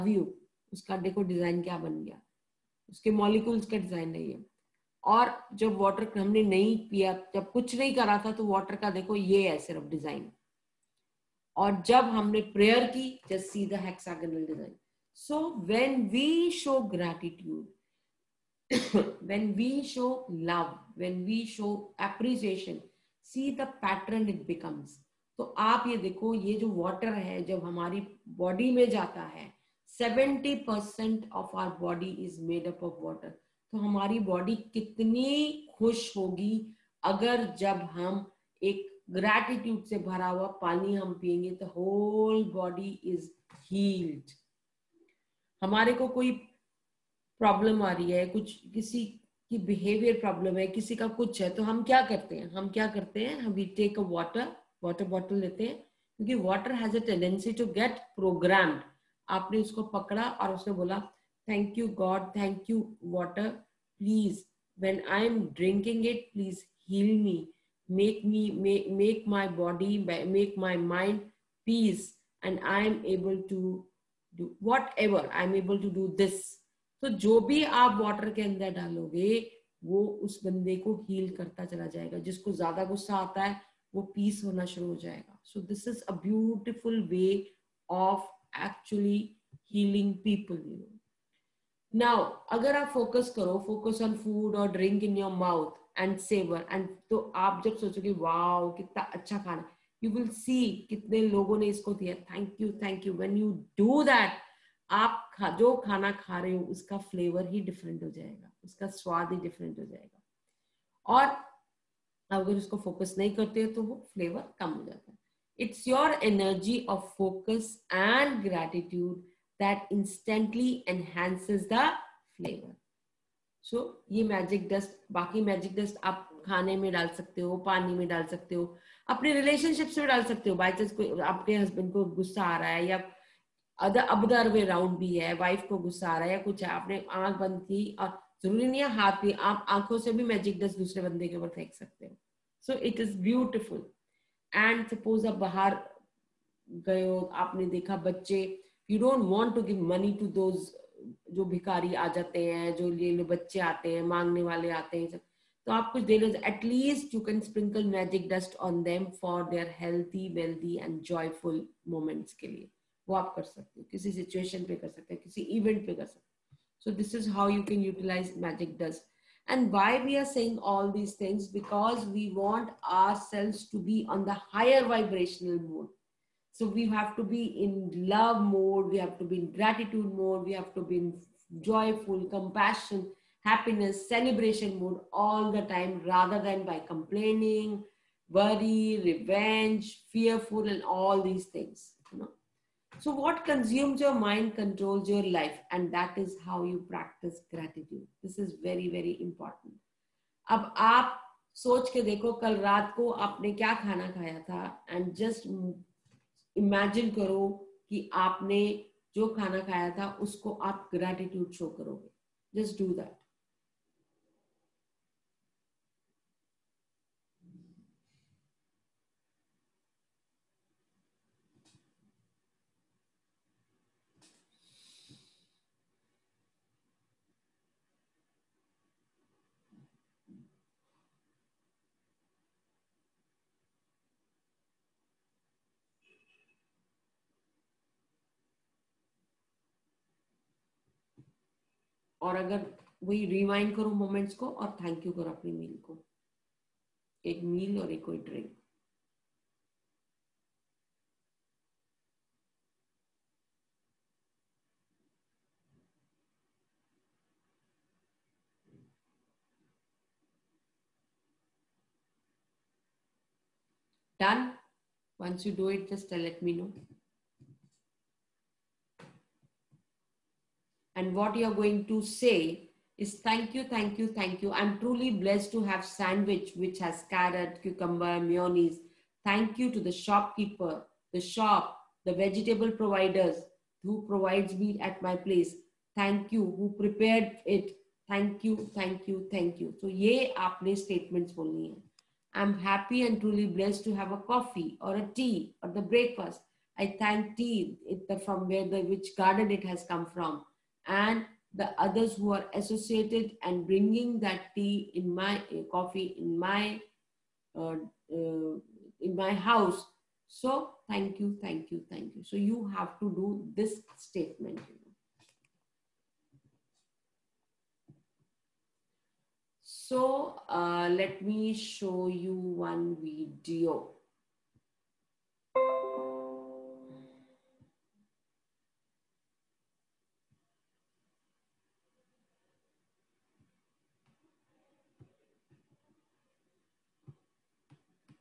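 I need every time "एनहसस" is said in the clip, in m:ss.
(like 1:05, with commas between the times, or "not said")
2:00.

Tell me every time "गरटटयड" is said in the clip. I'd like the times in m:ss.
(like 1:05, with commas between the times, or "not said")
0:16, 0:39, 1:58.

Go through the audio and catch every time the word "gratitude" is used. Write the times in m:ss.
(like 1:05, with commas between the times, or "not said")
2:59, 3:17, 3:30.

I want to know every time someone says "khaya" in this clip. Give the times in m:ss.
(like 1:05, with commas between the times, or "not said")
3:24, 3:29.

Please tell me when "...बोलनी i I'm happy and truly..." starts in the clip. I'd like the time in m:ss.
4:51.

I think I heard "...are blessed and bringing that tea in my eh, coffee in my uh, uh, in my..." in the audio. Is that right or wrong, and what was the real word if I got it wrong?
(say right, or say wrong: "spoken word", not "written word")
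wrong: "associated", not "blessed".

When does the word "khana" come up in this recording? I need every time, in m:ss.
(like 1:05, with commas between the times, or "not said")
3:23, 3:29.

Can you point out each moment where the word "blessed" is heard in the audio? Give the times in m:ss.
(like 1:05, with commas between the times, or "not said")
4:35, 4:53.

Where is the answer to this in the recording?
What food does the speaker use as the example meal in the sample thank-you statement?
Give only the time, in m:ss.
4:35.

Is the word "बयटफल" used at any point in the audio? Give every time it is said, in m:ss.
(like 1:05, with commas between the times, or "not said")
1:26, 2:23.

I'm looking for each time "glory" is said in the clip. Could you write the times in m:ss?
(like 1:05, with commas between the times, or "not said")
not said.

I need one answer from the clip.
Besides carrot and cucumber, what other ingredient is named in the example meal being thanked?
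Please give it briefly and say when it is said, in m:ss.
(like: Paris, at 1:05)
Mayonnaise, at 4:38.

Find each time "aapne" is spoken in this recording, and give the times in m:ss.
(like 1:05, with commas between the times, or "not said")
3:23, 3:28.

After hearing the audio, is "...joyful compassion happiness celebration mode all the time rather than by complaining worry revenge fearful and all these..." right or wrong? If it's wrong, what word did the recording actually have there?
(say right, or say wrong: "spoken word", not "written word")
right.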